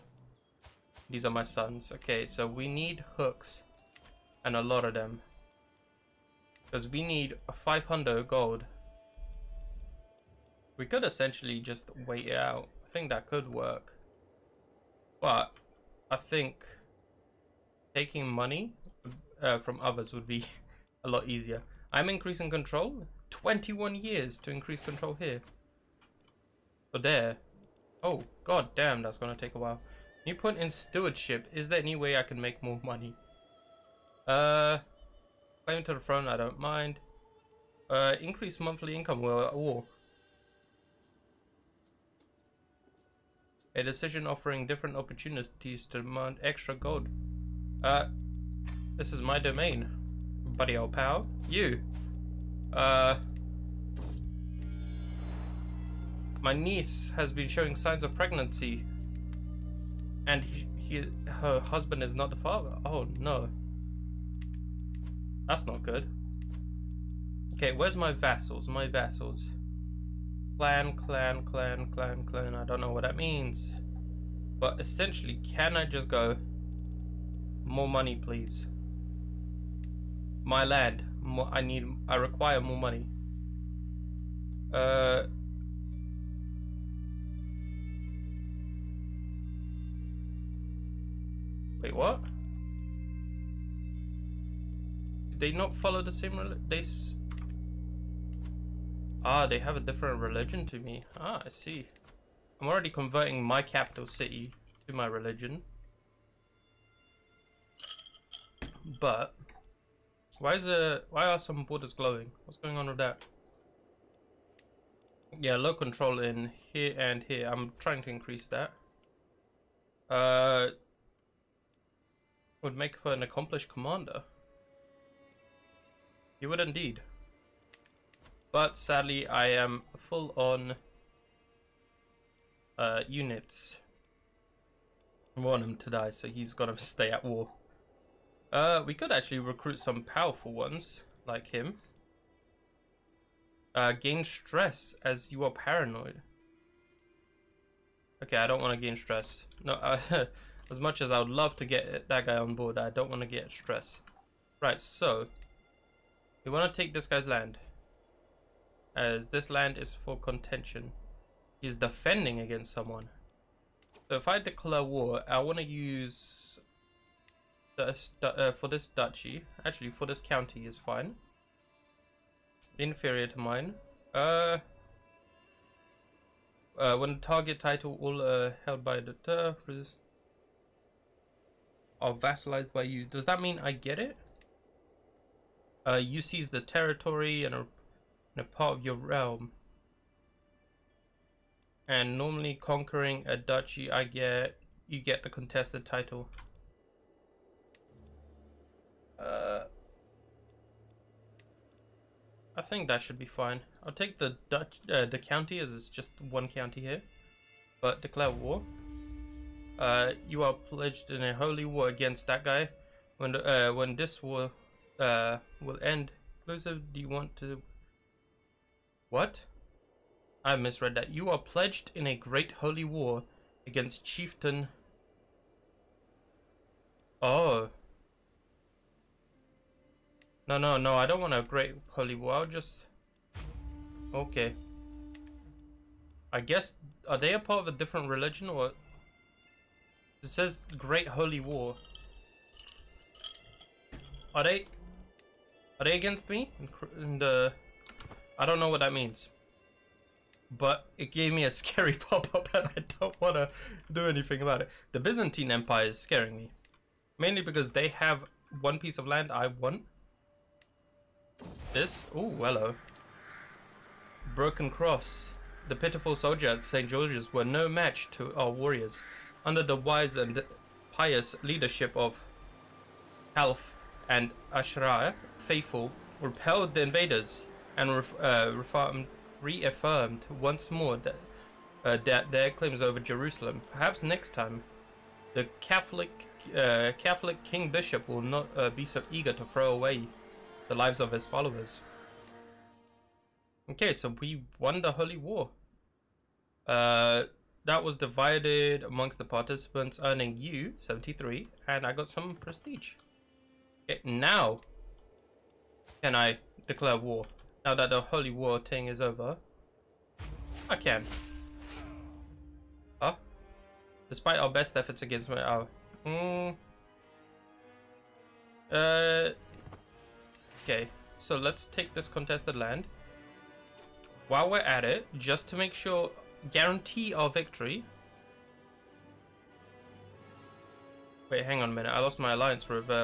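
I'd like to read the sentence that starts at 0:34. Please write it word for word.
Uh, claim to the throne, I don't mind.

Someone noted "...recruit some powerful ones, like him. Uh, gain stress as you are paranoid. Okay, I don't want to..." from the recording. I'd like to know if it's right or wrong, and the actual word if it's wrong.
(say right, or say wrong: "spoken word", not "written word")
right.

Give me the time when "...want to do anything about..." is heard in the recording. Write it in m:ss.
4:13.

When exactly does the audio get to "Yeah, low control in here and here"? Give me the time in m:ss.
1:55.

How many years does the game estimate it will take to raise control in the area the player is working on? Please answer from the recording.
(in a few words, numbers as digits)
21.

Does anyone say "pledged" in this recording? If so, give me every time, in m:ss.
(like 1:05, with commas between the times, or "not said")
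3:30, 3:41.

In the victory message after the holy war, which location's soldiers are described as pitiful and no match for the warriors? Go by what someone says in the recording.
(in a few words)
St. George's.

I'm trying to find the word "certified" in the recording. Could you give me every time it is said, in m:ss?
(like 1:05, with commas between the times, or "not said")
not said.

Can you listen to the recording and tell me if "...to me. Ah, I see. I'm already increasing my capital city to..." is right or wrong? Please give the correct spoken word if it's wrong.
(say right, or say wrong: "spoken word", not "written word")
wrong: "converting", not "increasing".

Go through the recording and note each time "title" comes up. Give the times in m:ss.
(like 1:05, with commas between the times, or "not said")
2:57, 3:15.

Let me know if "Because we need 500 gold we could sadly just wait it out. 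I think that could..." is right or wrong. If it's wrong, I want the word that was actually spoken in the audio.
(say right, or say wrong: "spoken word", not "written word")
wrong: "essentially", not "sadly".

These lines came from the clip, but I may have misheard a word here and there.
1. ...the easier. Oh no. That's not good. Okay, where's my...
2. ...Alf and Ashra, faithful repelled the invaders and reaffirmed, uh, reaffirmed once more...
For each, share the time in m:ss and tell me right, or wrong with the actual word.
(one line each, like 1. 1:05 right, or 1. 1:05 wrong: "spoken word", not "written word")
1. 1:02 wrong: "father", not "easier"
2. 4:33 right.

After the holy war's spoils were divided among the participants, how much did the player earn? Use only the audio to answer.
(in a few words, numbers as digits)
73.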